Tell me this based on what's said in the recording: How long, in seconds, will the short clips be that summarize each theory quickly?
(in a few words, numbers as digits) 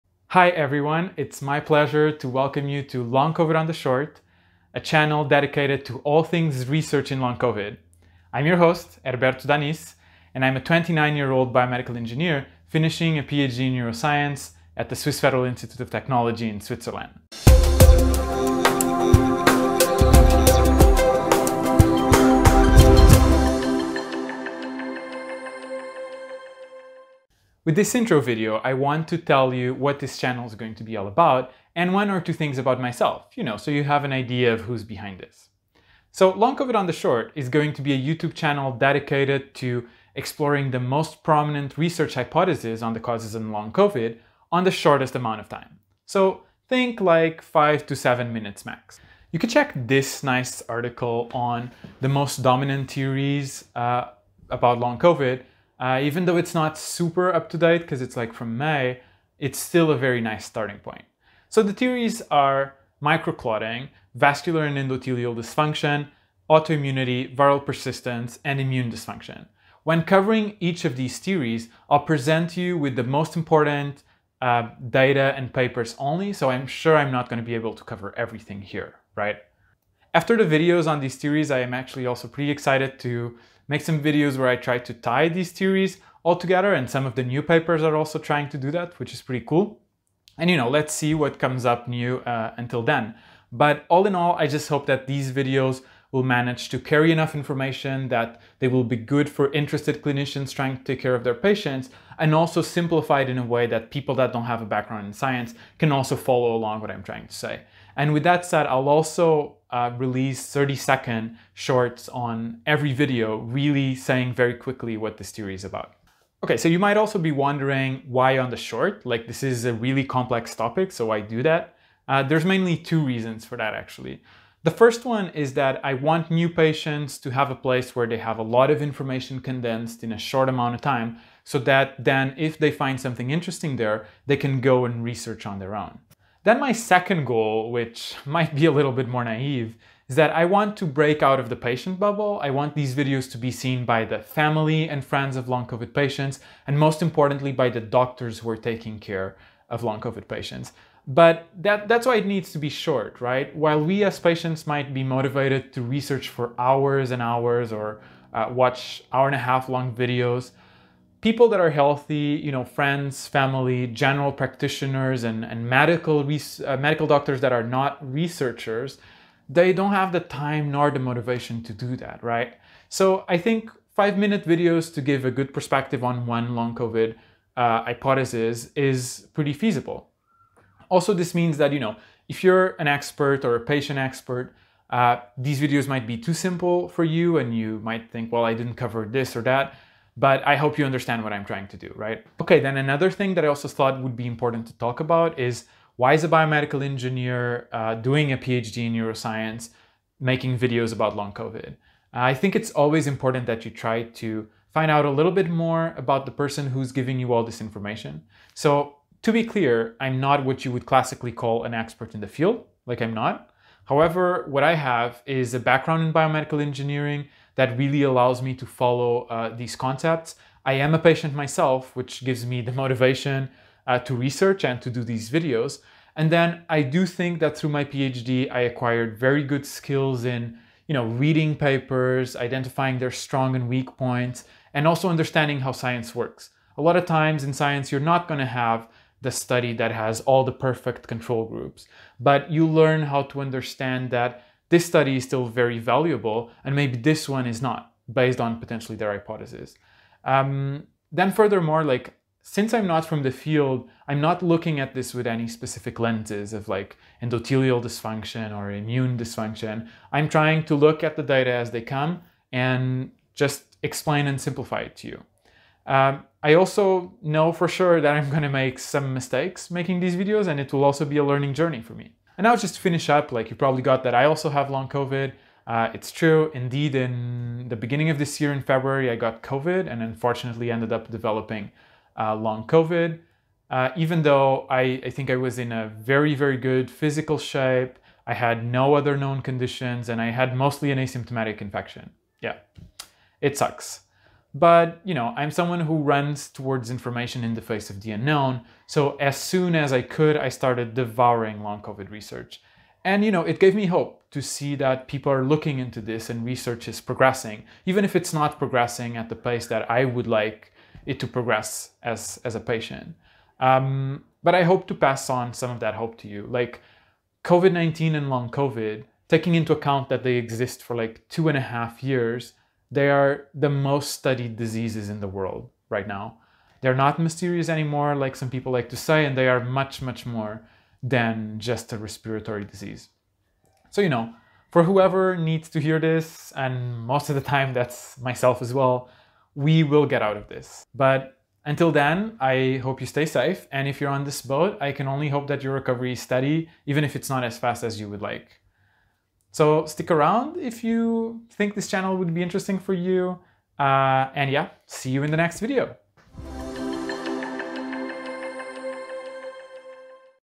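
30.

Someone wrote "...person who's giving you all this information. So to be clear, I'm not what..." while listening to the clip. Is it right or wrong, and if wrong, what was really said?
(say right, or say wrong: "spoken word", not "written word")
right.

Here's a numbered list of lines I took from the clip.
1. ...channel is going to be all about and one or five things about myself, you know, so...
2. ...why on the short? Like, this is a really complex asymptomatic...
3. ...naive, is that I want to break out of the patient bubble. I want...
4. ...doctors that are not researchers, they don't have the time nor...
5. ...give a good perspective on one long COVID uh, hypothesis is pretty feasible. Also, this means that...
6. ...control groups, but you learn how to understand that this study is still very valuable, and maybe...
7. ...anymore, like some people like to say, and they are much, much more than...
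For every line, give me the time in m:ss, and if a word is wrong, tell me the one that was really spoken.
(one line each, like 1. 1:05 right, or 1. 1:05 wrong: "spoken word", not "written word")
1. 0:30 wrong: "two", not "five"
2. 1:58 wrong: "topic", not "asymptomatic"
3. 2:19 right
4. 2:47 right
5. 2:55 right
6. 4:01 right
7. 5:27 right.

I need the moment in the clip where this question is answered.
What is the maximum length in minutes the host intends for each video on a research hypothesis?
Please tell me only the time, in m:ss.
0:47.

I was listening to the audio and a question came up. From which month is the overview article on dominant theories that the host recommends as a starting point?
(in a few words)
May.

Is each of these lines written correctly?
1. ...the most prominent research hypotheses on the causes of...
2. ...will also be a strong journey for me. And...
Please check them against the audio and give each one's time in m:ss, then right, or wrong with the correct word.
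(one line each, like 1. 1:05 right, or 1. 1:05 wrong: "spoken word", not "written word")
1. 0:40 right
2. 4:30 wrong: "learning", not "strong".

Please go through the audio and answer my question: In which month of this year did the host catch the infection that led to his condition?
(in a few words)
February.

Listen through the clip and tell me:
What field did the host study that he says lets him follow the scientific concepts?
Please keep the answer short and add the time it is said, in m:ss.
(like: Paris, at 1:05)
biomedical engineering, at 3:36.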